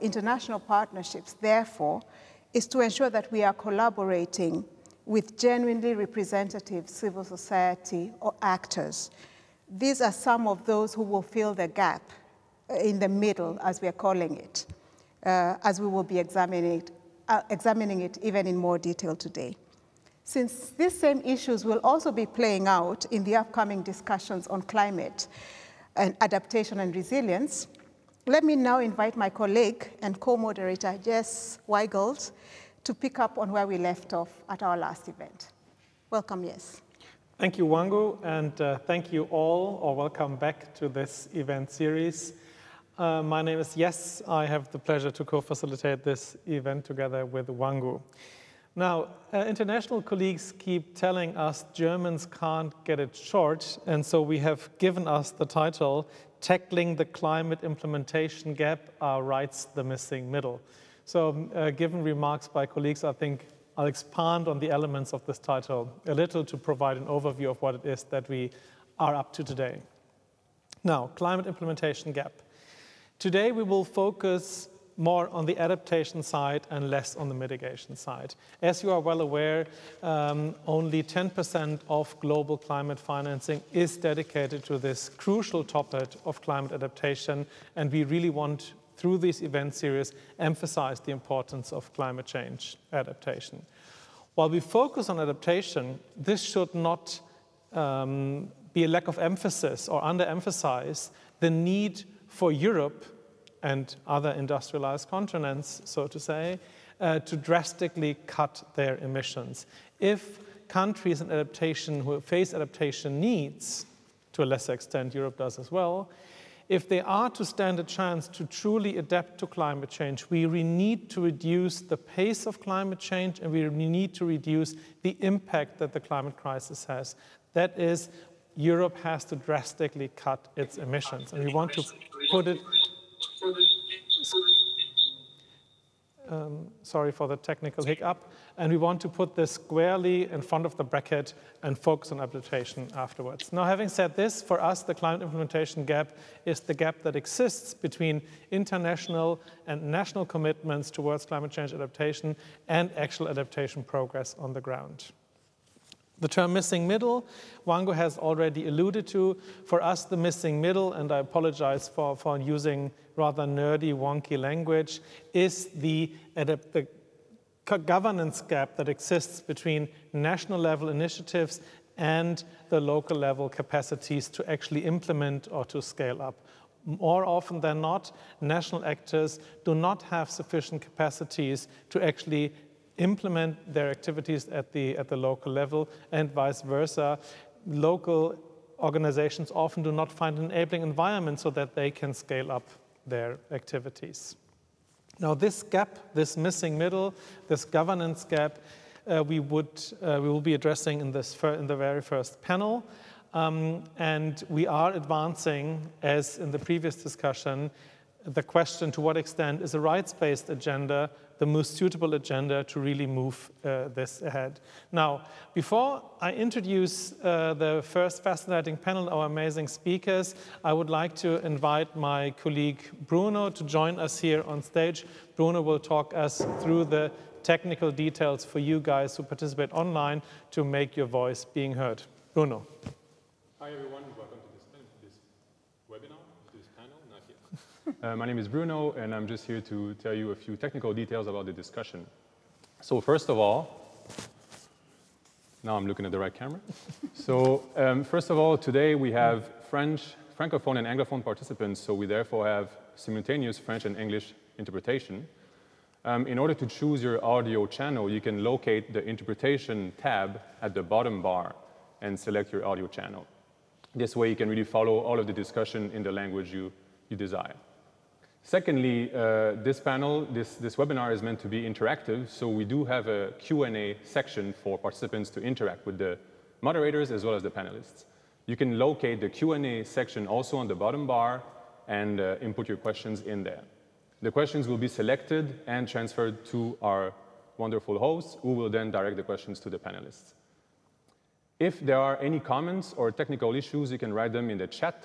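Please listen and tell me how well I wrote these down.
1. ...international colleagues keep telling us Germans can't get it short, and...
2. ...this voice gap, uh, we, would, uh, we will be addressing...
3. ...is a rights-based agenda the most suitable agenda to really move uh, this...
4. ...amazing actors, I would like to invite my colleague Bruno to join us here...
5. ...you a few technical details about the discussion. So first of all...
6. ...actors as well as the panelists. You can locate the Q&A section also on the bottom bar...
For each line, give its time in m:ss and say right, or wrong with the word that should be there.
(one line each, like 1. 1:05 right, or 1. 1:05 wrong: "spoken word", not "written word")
1. 0:49 right
2. 3:17 wrong: "governance", not "voice"
3. 3:29 right
4. 3:39 wrong: "speakers", not "actors"
5. 4:00 right
6. 4:36 wrong: "moderators", not "actors".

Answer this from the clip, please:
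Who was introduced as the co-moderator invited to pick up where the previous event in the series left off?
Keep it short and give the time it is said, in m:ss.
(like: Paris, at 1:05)
Jes Weigelt, at 0:31.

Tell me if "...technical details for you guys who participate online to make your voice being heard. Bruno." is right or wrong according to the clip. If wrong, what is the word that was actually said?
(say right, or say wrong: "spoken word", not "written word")
right.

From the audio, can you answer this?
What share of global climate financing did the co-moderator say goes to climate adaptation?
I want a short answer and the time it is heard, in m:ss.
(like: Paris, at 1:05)
10%, at 1:21.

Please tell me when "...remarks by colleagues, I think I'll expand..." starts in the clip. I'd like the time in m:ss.
1:02.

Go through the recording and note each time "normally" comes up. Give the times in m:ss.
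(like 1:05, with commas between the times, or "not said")
not said.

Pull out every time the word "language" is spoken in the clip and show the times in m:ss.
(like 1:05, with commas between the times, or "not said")
2:44, 4:26.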